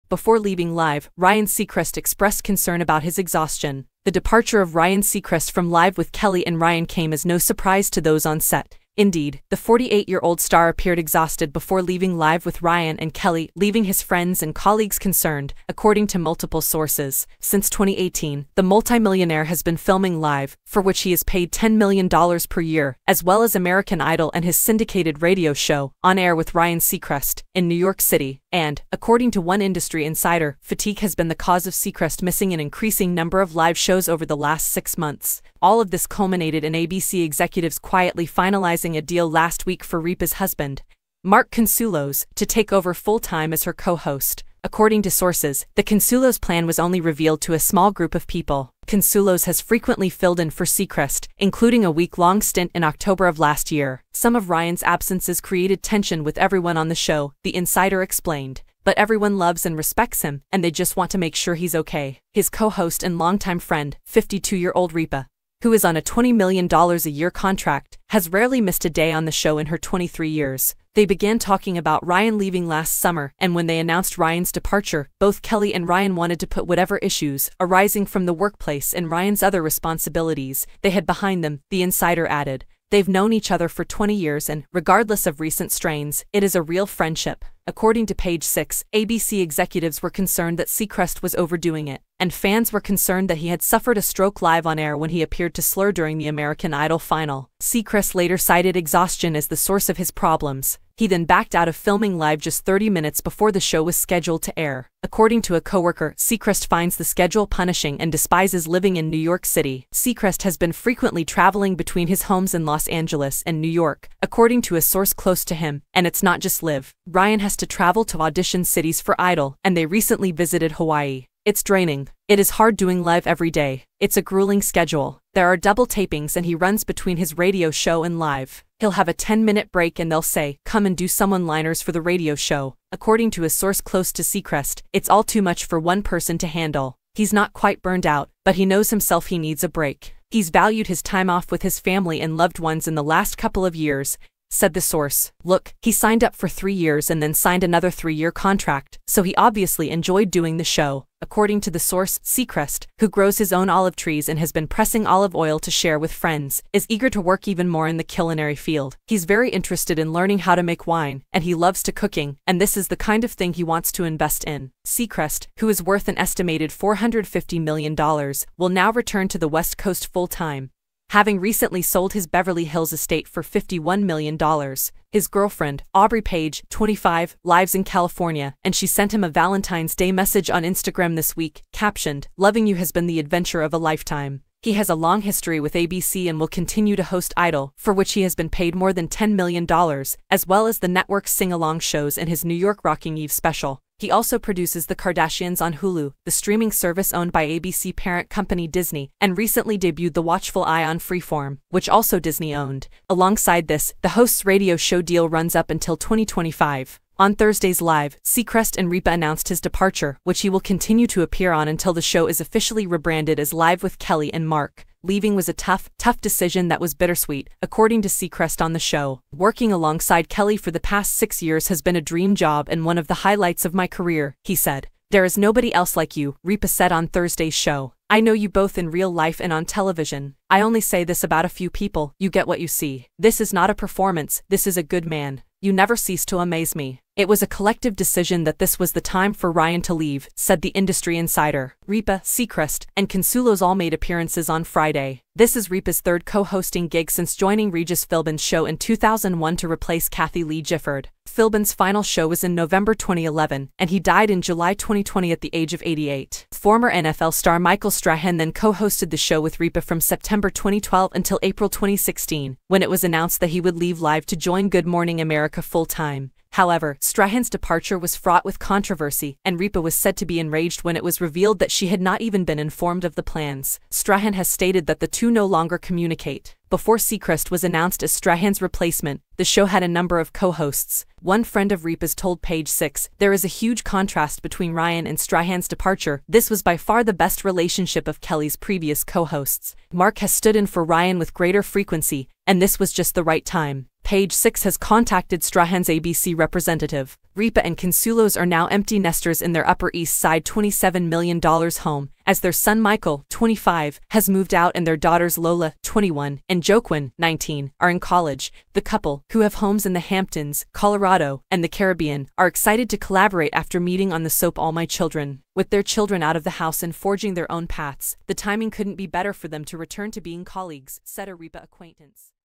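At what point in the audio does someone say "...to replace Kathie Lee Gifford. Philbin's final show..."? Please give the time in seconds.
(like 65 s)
249 s.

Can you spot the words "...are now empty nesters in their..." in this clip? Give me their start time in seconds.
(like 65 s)
298 s.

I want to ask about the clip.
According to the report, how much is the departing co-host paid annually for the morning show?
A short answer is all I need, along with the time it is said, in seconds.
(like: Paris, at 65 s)
$10 million per year, at 21 s.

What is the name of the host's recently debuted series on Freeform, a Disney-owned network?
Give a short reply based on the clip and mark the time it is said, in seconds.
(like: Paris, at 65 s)
The Watchful Eye, at 200 s.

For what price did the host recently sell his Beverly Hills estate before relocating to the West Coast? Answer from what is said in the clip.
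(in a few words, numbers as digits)
$51 million.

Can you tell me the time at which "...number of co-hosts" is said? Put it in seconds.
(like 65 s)
279 s.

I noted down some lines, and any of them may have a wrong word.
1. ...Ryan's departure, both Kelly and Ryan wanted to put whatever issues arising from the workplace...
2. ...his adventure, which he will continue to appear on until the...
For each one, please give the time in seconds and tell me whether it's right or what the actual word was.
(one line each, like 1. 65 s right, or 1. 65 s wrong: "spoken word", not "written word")
1. 74 s right
2. 209 s wrong: "departure", not "adventure".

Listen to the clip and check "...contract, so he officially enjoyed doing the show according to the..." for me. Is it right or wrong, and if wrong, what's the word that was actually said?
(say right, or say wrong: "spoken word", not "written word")
wrong: "obviously", not "officially".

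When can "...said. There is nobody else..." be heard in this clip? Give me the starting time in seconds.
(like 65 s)
224 s.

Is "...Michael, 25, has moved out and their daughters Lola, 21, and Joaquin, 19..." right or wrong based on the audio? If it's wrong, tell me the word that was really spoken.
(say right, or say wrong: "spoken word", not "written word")
right.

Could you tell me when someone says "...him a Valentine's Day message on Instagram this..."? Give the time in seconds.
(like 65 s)
179 s.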